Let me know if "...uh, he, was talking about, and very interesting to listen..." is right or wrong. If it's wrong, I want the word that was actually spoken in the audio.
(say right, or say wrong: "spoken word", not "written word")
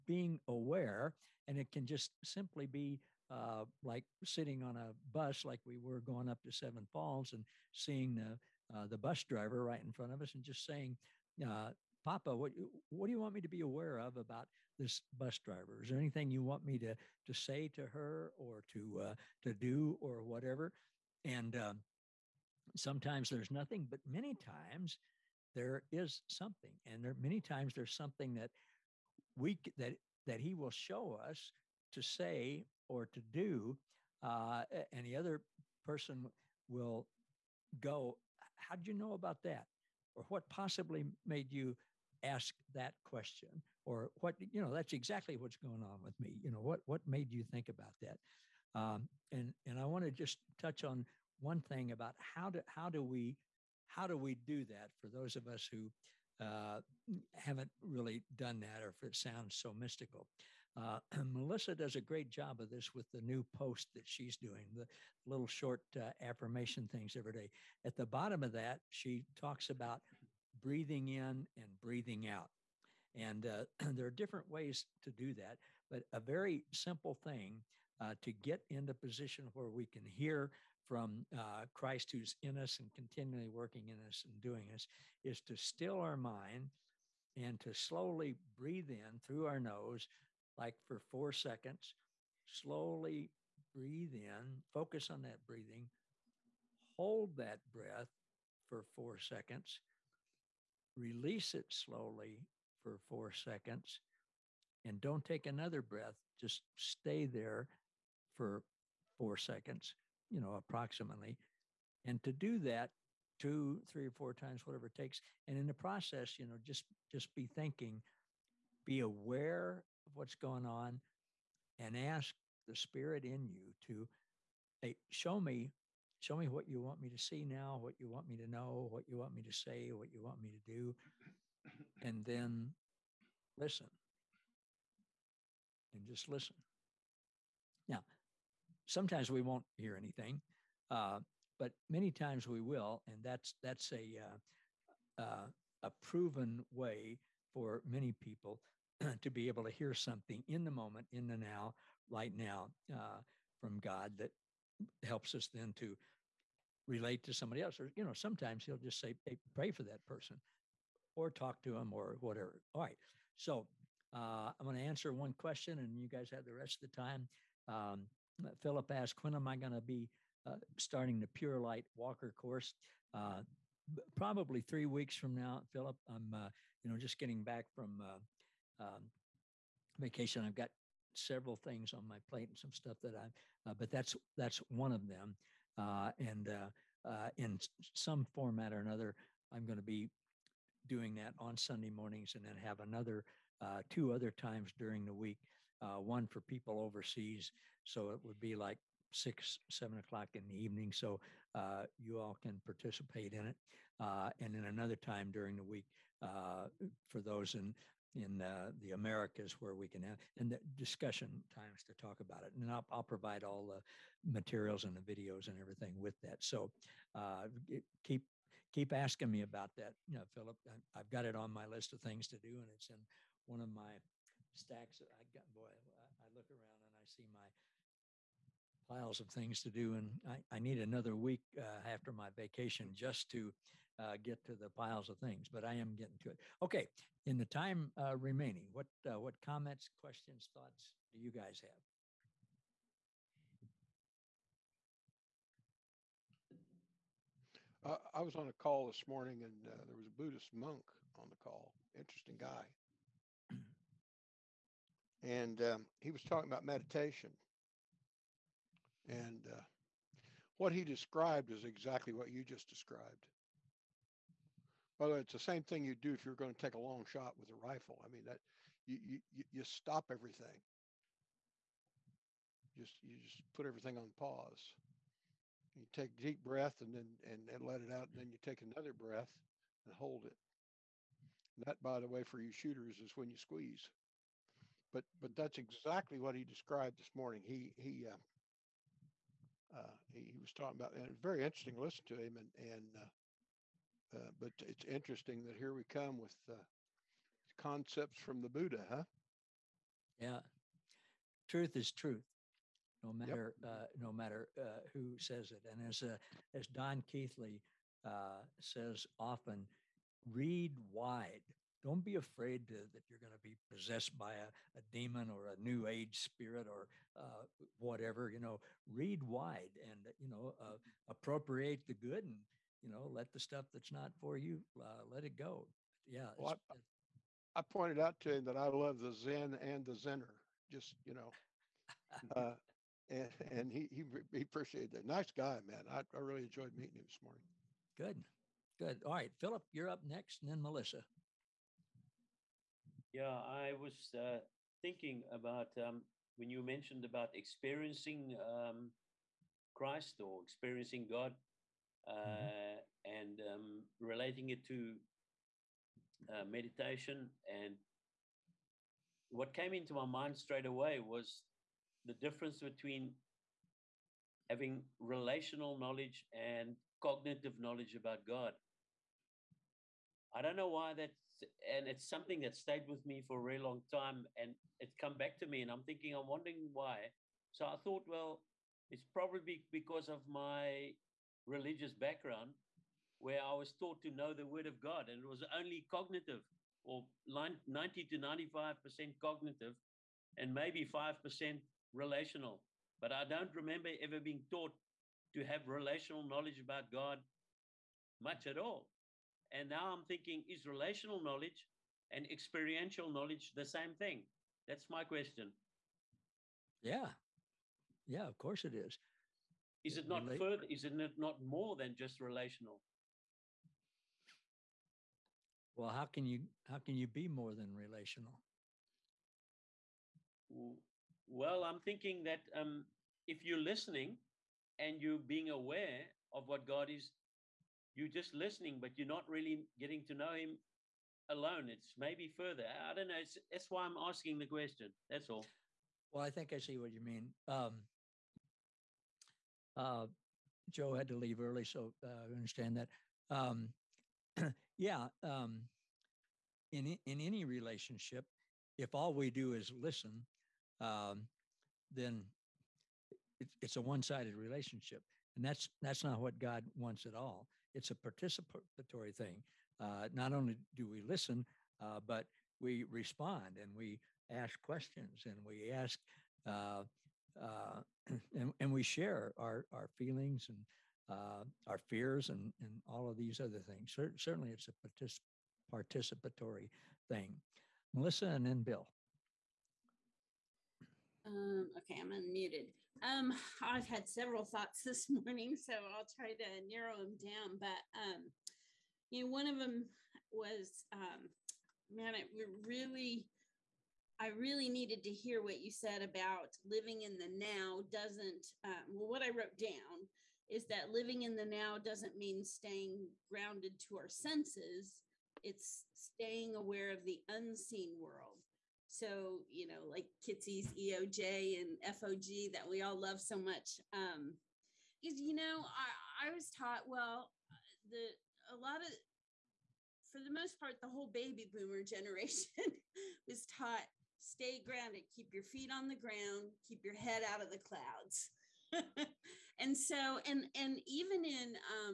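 right.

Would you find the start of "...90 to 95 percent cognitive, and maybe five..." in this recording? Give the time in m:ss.
6:27.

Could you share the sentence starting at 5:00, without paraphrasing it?
Yeah, truth is truth, no matter yep.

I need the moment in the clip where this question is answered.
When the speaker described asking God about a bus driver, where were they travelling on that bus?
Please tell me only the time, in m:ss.
0:06.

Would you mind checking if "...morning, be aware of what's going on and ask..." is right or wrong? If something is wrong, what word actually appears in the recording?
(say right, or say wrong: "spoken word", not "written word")
wrong: "thinking", not "morning".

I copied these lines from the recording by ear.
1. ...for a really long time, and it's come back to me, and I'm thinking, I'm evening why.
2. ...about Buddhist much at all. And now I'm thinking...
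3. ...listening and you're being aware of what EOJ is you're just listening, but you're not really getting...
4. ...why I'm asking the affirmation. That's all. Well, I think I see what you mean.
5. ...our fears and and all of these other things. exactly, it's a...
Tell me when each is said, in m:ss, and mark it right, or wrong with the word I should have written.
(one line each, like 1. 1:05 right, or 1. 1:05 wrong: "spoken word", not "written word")
1. 6:13 wrong: "wondering", not "evening"
2. 6:36 wrong: "God", not "Buddhist"
3. 7:03 wrong: "God", not "EOJ"
4. 7:13 wrong: "question", not "affirmation"
5. 7:51 wrong: "certainly", not "exactly".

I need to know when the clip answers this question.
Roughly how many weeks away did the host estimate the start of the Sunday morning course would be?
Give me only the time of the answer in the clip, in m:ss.
2:54.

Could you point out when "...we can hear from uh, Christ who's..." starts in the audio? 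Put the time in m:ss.
1:19.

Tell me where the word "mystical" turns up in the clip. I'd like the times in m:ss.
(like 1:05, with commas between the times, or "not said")
0:59.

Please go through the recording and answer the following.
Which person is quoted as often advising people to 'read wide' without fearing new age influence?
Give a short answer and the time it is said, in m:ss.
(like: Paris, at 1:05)
Don Keathley, at 5:06.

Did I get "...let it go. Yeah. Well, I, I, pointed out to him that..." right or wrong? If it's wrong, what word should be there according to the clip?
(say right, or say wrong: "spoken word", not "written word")
right.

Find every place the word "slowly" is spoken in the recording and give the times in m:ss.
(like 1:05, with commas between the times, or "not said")
1:27, 1:32, 1:41.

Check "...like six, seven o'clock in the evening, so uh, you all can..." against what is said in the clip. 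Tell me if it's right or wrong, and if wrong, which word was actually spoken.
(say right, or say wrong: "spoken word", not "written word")
right.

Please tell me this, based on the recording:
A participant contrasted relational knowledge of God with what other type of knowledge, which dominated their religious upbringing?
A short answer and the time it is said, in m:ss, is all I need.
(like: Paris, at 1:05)
Cognitive knowledge, at 6:07.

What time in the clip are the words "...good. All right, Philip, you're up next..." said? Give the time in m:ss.
5:38.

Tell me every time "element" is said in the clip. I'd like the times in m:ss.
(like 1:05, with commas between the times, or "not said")
not said.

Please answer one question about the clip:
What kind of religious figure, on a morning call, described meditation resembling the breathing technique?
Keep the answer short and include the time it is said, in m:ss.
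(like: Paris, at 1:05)
Buddhist monk, at 4:10.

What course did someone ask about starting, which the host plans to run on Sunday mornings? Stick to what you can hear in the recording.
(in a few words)
Pure Light Walker.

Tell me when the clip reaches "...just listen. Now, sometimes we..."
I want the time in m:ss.
2:16.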